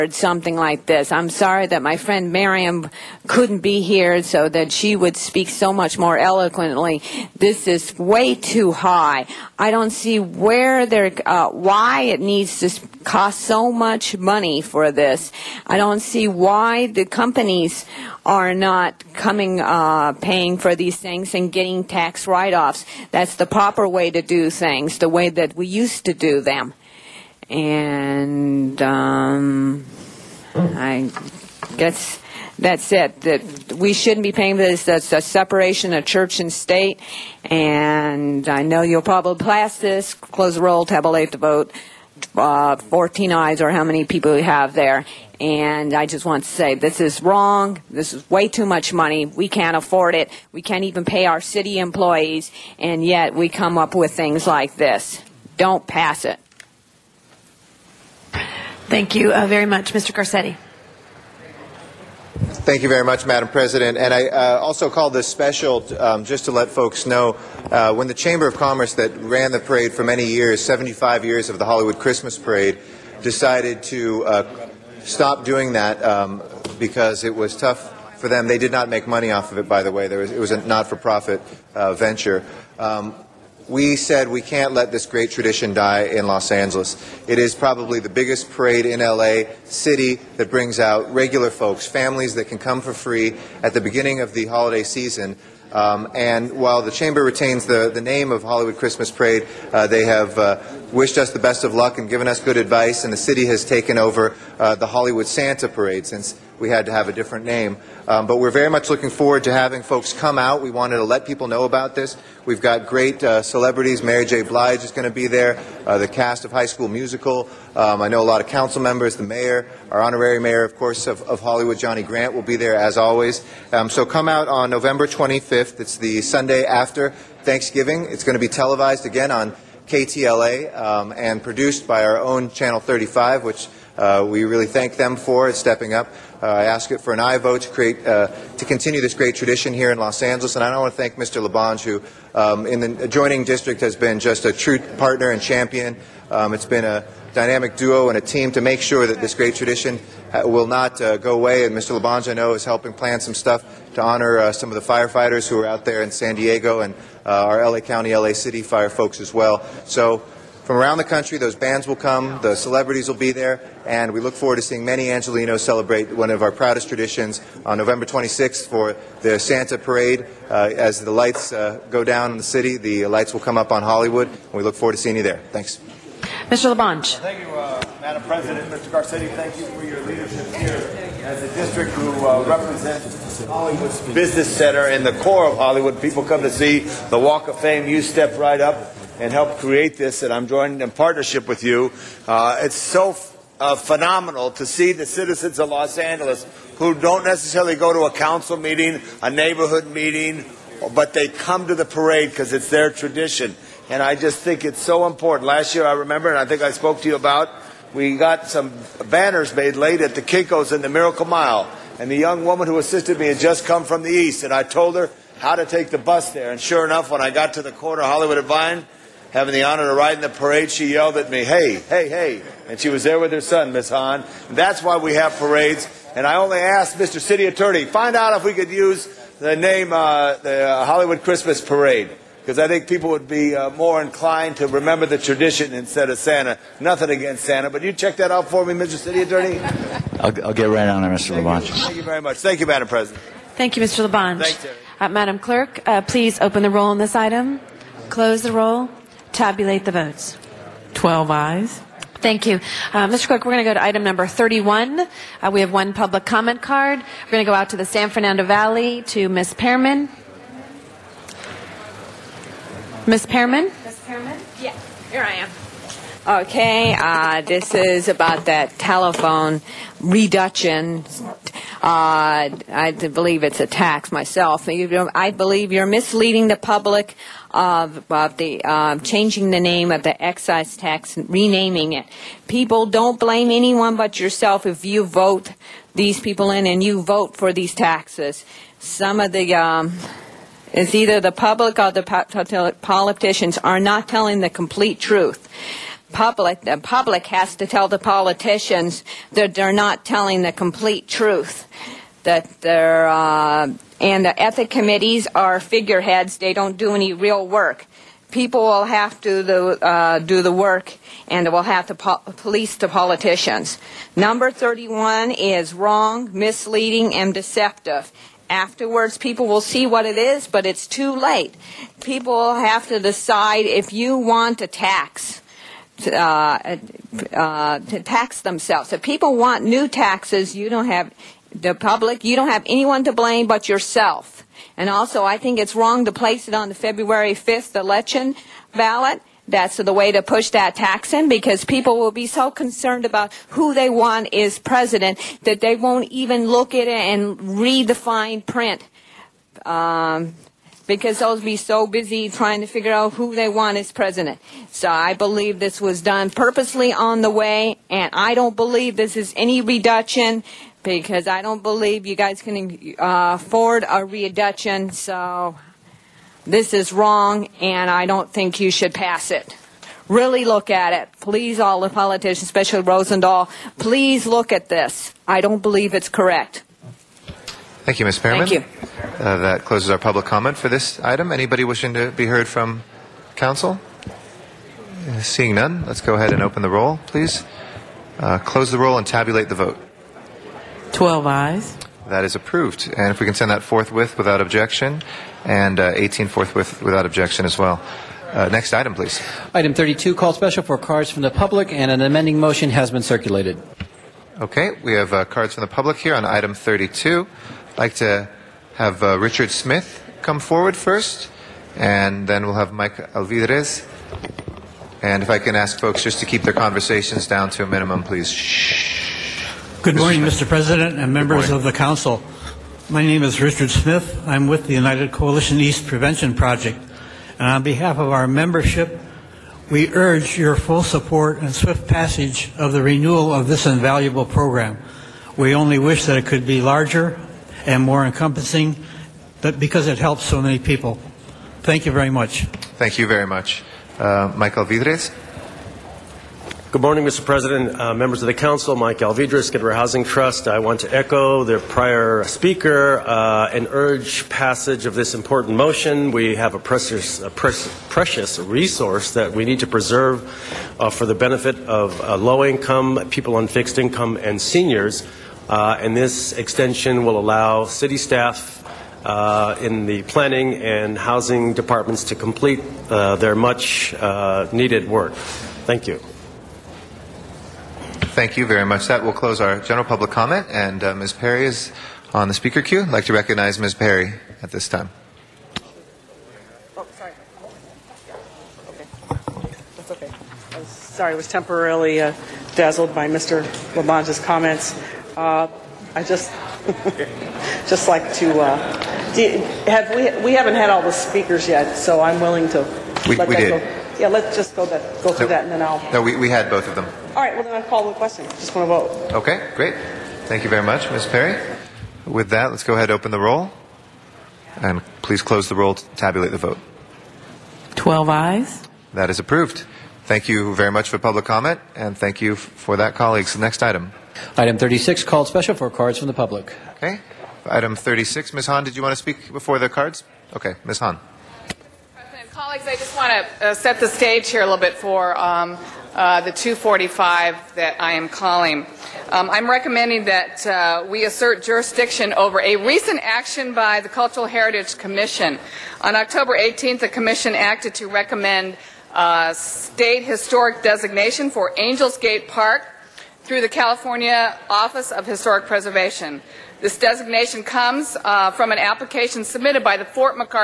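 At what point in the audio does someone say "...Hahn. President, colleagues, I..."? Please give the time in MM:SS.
08:50.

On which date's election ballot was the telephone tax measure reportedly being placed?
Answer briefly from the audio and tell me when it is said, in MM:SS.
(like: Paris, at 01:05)
February 5th, at 05:36.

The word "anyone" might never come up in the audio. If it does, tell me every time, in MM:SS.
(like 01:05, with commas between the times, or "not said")
04:43, 05:32.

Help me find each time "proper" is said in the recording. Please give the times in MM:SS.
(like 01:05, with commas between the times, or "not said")
00:23.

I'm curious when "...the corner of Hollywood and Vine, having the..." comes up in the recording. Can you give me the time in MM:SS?
03:37.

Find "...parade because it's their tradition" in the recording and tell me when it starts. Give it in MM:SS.
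03:21.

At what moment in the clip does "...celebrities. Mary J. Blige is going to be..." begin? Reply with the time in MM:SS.
01:53.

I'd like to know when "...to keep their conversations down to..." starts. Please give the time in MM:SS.
06:56.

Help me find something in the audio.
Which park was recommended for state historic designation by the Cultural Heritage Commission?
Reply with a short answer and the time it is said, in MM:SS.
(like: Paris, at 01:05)
Angels Gate Park, at 09:11.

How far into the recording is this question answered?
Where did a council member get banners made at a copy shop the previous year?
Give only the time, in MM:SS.
03:30.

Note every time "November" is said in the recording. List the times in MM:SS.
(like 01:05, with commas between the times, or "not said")
02:04, 02:47.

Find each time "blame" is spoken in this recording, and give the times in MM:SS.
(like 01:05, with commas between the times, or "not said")
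04:43, 05:33.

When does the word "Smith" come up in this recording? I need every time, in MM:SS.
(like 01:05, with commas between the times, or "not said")
06:49, 07:03.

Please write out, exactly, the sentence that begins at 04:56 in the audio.
Public, the public has to tell the politicians that they're not telling the complete truth.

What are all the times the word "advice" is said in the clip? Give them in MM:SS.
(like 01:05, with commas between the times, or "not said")
01:42.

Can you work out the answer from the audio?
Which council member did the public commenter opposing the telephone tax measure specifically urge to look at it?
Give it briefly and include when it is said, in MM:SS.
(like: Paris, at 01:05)
Rosendahl, at 06:12.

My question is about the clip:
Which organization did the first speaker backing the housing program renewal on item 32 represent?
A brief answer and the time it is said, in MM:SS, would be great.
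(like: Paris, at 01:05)
United Coalition East Prevention Project, at 07:04.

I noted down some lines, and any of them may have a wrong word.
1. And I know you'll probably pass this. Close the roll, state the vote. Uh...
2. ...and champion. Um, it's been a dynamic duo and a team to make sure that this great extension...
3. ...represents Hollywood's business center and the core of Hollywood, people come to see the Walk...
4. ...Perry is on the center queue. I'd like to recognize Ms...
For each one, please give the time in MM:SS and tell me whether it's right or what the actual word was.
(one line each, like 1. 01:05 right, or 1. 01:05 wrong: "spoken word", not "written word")
1. 00:37 wrong: "tabulate", not "state"
2. 02:25 wrong: "tradition", not "extension"
3. 03:02 right
4. 08:01 wrong: "speaker", not "center".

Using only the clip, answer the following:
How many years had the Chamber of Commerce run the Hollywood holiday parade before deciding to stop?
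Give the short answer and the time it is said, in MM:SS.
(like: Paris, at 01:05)
75, at 01:10.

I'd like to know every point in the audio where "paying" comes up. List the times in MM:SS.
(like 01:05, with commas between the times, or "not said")
00:20, 00:34.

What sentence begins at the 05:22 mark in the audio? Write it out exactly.
People have to decide if you want a tax.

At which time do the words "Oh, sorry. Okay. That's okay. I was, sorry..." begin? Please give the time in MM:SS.
08:06.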